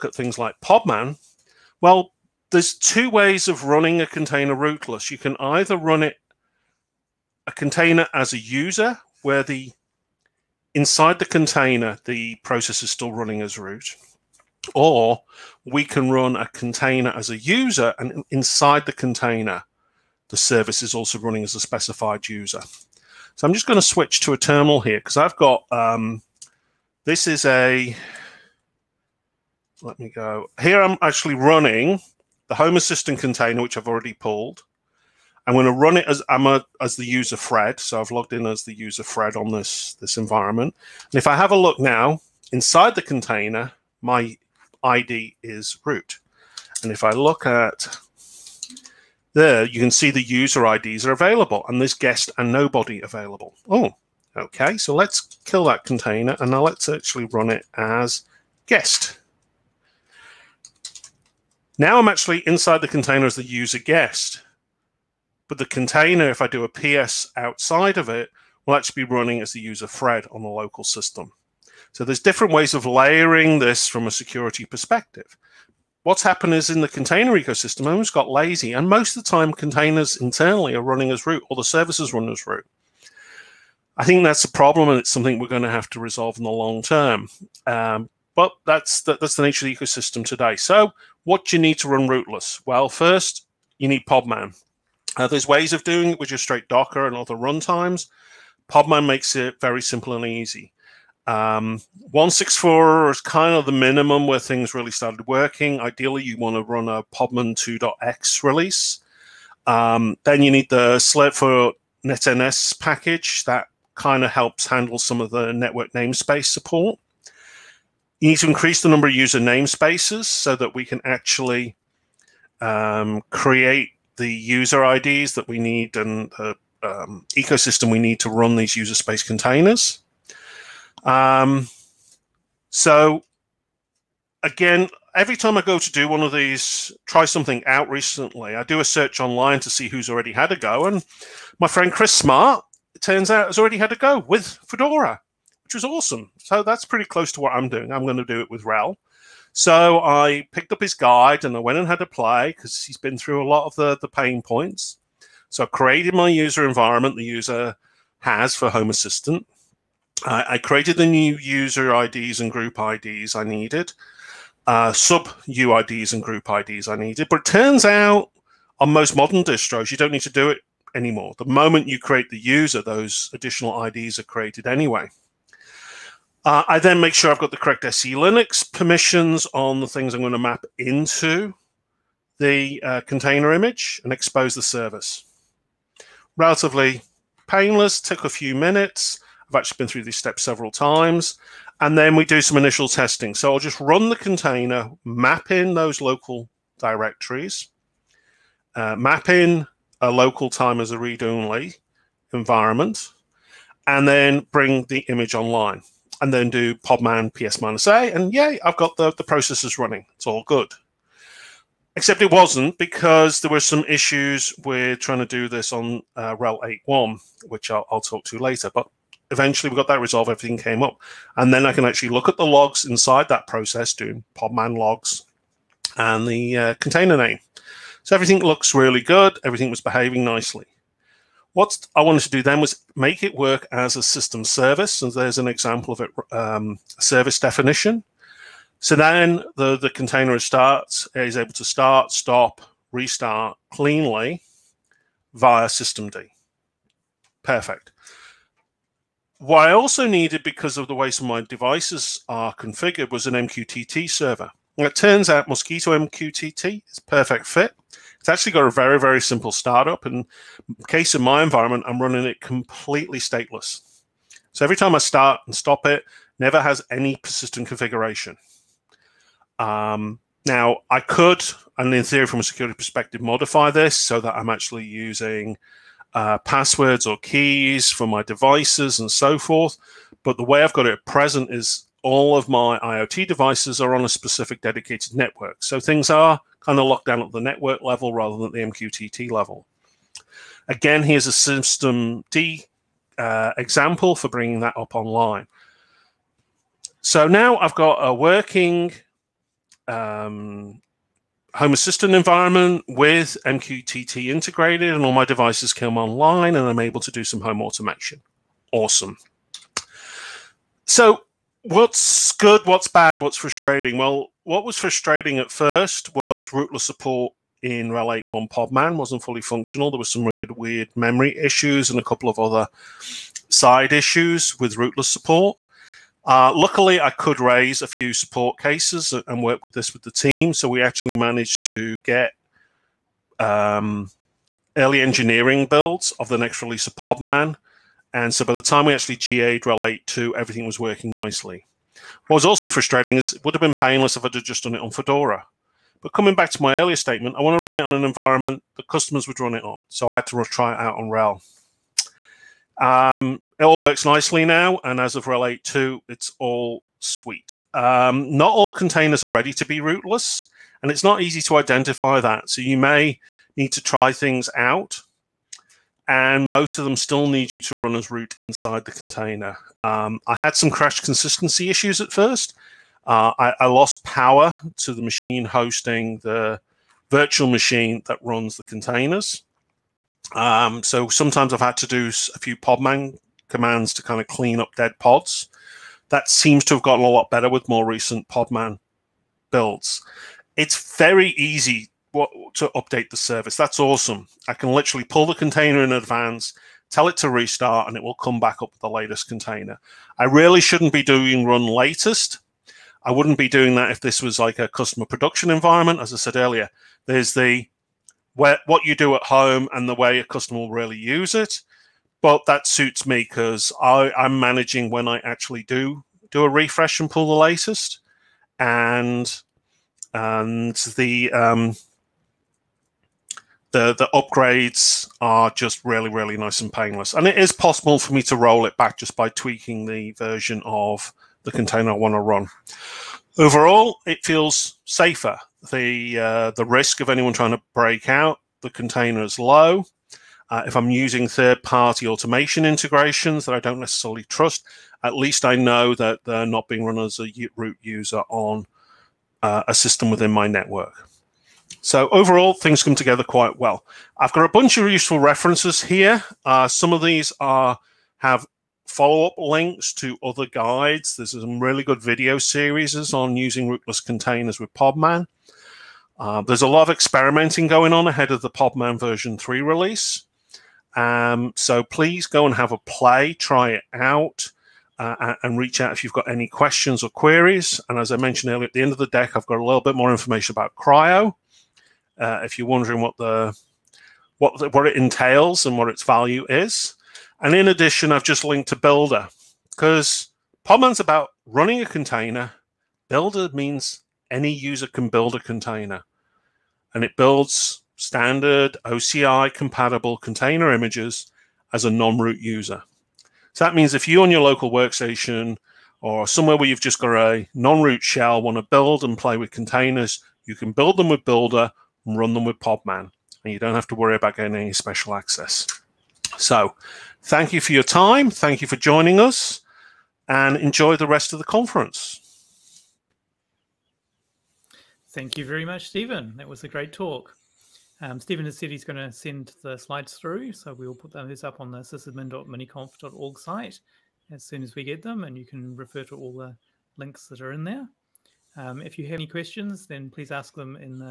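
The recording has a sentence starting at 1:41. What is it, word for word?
Um, 164 is kind of the minimum where things really started working.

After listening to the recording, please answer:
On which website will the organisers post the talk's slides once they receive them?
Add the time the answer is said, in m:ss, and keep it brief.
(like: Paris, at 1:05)
sysadmin.miniconf.org, at 8:51.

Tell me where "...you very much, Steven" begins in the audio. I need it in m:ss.
8:45.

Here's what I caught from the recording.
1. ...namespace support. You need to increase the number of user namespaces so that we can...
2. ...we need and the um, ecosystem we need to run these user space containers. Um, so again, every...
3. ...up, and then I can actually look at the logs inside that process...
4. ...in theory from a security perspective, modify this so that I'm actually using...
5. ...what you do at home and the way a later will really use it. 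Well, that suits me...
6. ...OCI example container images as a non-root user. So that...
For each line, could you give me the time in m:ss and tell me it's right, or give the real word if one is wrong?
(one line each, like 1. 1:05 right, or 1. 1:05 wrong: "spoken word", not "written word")
1. 1:55 right
2. 2:05 right
3. 3:40 right
4. 4:31 right
5. 6:48 wrong: "customer", not "later"
6. 8:18 wrong: "compatible", not "example".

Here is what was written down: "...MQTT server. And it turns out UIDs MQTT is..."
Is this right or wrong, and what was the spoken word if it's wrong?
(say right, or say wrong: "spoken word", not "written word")
wrong: "Mosquitto", not "UIDs".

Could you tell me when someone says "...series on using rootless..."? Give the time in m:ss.
7:42.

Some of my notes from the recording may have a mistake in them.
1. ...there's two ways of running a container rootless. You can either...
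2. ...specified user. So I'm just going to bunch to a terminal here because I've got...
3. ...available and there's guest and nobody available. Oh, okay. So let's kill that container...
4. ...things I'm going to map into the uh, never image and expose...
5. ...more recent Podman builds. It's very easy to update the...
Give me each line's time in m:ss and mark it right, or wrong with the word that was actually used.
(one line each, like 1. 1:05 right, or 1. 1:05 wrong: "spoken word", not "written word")
1. 0:02 right
2. 0:21 wrong: "switch", not "bunch"
3. 0:51 right
4. 2:59 wrong: "container", not "never"
5. 6:27 right.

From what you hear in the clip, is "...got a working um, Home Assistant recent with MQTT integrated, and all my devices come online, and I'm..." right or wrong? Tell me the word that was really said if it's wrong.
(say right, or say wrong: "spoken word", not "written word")
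wrong: "environment", not "recent".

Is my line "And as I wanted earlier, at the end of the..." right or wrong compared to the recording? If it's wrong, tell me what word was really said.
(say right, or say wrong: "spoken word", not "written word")
wrong: "mentioned", not "wanted".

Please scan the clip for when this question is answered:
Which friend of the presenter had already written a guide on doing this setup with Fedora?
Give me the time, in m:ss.
2:21.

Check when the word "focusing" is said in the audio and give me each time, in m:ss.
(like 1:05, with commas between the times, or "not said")
not said.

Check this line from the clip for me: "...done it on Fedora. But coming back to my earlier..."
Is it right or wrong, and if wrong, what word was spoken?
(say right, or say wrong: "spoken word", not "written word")
right.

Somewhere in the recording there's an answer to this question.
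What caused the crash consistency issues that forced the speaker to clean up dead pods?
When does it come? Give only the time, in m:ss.
6:13.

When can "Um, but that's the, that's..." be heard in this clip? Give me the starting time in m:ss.
1:27.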